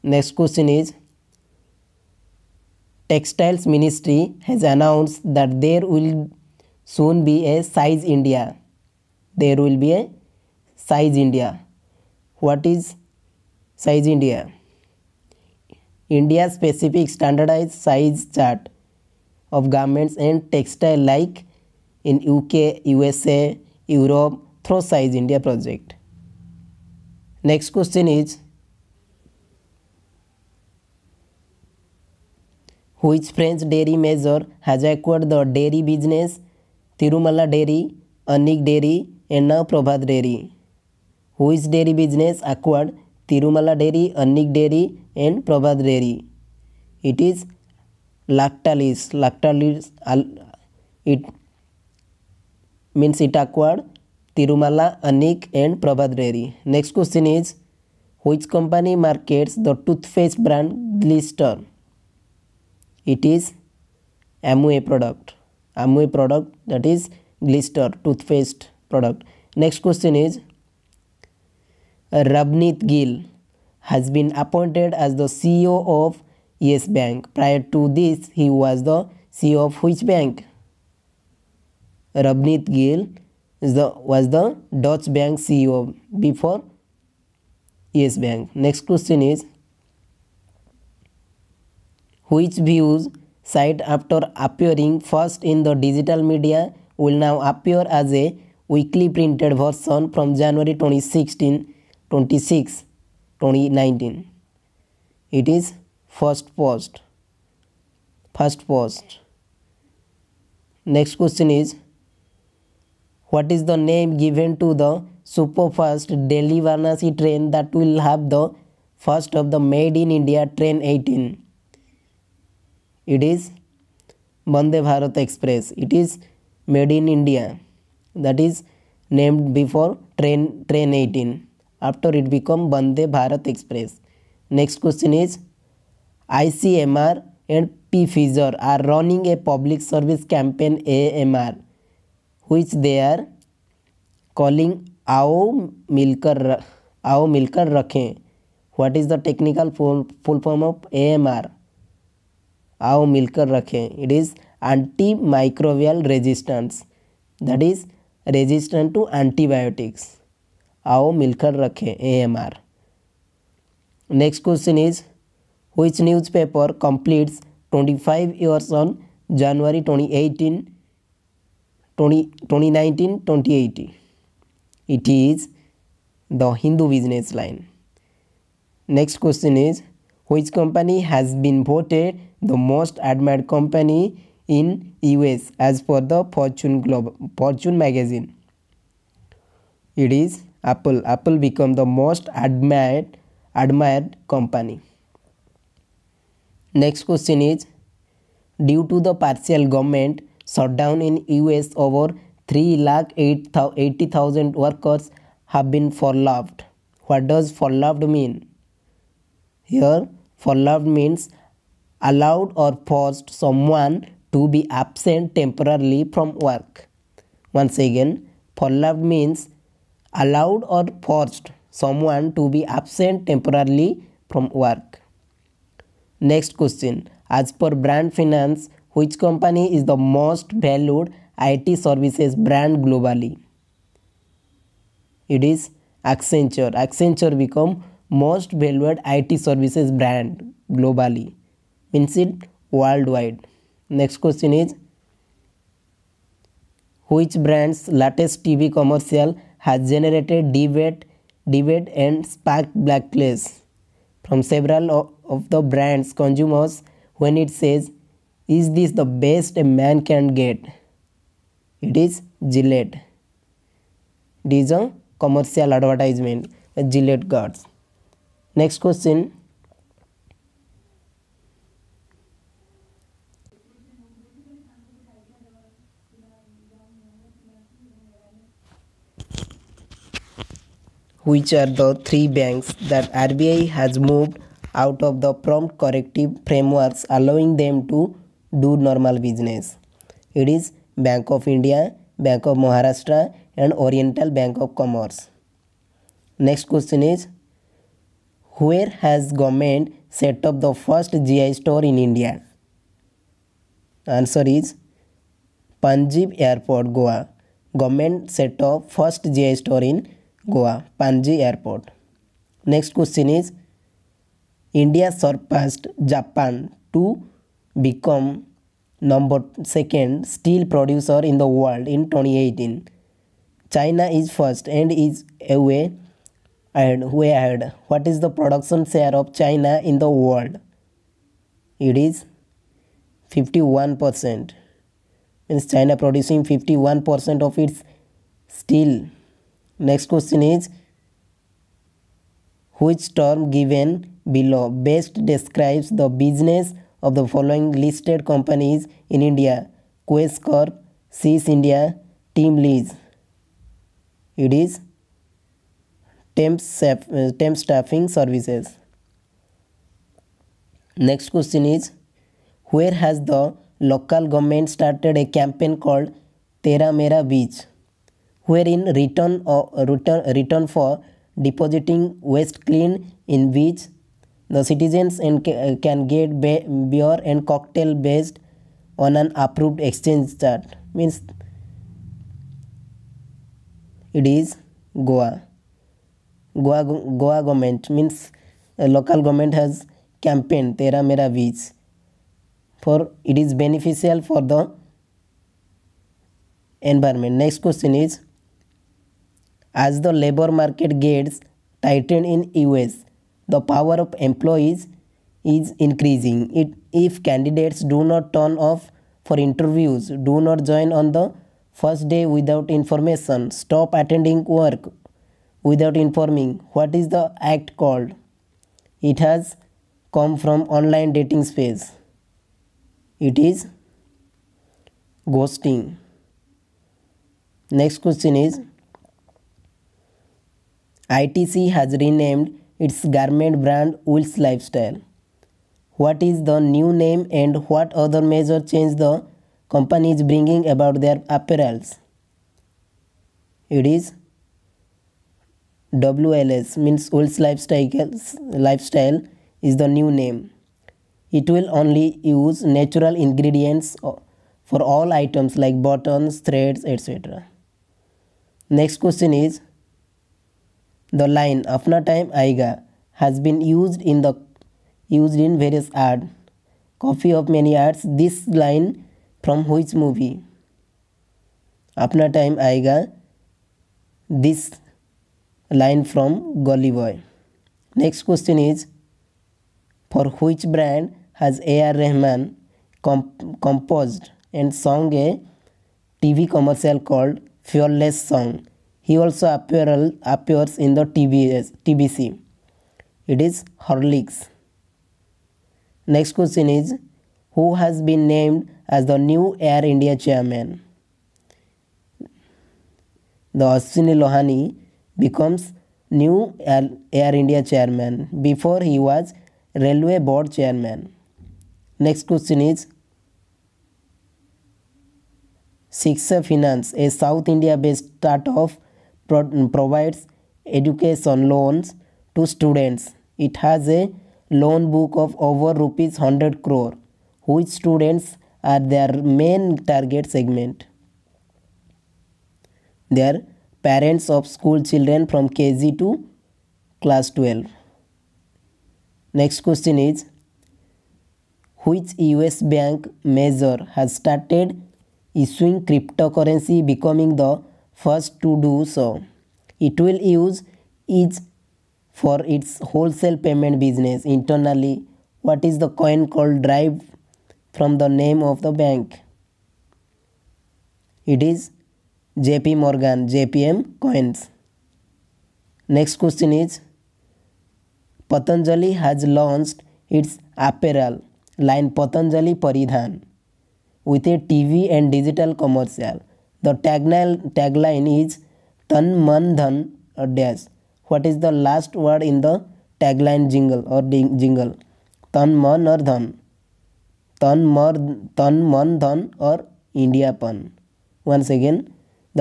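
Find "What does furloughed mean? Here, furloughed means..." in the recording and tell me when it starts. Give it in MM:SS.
03:27.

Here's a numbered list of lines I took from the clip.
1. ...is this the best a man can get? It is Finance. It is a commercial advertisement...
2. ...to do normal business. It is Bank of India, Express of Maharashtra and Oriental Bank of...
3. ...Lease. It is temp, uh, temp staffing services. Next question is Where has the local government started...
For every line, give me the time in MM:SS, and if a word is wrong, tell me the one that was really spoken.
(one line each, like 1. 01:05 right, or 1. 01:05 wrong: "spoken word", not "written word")
1. 04:18 wrong: "Gillette", not "Finance"
2. 04:47 wrong: "Bank", not "Express"
3. 05:52 right.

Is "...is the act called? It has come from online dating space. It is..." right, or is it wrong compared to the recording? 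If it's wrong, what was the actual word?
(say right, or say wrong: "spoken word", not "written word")
right.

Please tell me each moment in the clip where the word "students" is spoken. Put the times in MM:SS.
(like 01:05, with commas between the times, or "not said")
08:42, 08:47.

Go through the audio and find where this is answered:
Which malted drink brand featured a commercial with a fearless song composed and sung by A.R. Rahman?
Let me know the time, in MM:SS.
08:13.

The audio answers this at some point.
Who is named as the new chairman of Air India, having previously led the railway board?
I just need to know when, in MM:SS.
08:23.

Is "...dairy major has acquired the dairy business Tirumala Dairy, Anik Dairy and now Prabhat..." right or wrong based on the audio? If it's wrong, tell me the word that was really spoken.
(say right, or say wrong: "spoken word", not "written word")
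right.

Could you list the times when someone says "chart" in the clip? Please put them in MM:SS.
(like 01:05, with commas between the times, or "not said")
00:18, 06:20.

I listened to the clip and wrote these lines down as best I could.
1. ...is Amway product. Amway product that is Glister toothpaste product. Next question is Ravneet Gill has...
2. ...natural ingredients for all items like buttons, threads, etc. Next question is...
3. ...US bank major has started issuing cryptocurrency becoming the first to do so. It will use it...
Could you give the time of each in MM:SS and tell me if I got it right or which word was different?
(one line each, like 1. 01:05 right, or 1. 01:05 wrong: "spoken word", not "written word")
1. 01:03 right
2. 07:32 right
3. 09:02 right.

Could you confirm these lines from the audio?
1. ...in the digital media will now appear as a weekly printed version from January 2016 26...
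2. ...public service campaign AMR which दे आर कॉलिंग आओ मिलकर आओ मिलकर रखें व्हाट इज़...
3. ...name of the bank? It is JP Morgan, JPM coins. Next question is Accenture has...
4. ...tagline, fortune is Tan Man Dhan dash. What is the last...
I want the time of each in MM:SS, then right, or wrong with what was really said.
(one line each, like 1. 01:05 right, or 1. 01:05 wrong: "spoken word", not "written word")
1. 01:35 right
2. 02:19 right
3. 09:18 wrong: "Patanjali", not "Accenture"
4. 09:36 wrong: "tagline", not "fortune".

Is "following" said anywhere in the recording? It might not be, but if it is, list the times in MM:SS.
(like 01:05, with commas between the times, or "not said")
05:47.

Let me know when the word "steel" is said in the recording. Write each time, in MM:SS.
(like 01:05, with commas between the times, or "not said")
05:20, 05:38.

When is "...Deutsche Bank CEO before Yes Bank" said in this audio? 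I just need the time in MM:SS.
01:24.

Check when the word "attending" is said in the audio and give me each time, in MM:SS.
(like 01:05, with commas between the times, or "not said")
06:53.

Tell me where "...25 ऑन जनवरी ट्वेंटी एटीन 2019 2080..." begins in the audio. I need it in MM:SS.
02:48.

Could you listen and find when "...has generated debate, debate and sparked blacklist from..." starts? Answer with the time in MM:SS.
04:09.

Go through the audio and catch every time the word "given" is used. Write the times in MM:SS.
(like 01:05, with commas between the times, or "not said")
01:54, 05:43.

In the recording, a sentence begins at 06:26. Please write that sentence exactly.
Goa, Goa government means local government has campaigned Tera Mera Beach for it is beneficial for the environment.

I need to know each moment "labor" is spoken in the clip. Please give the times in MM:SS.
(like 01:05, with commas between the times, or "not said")
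06:40.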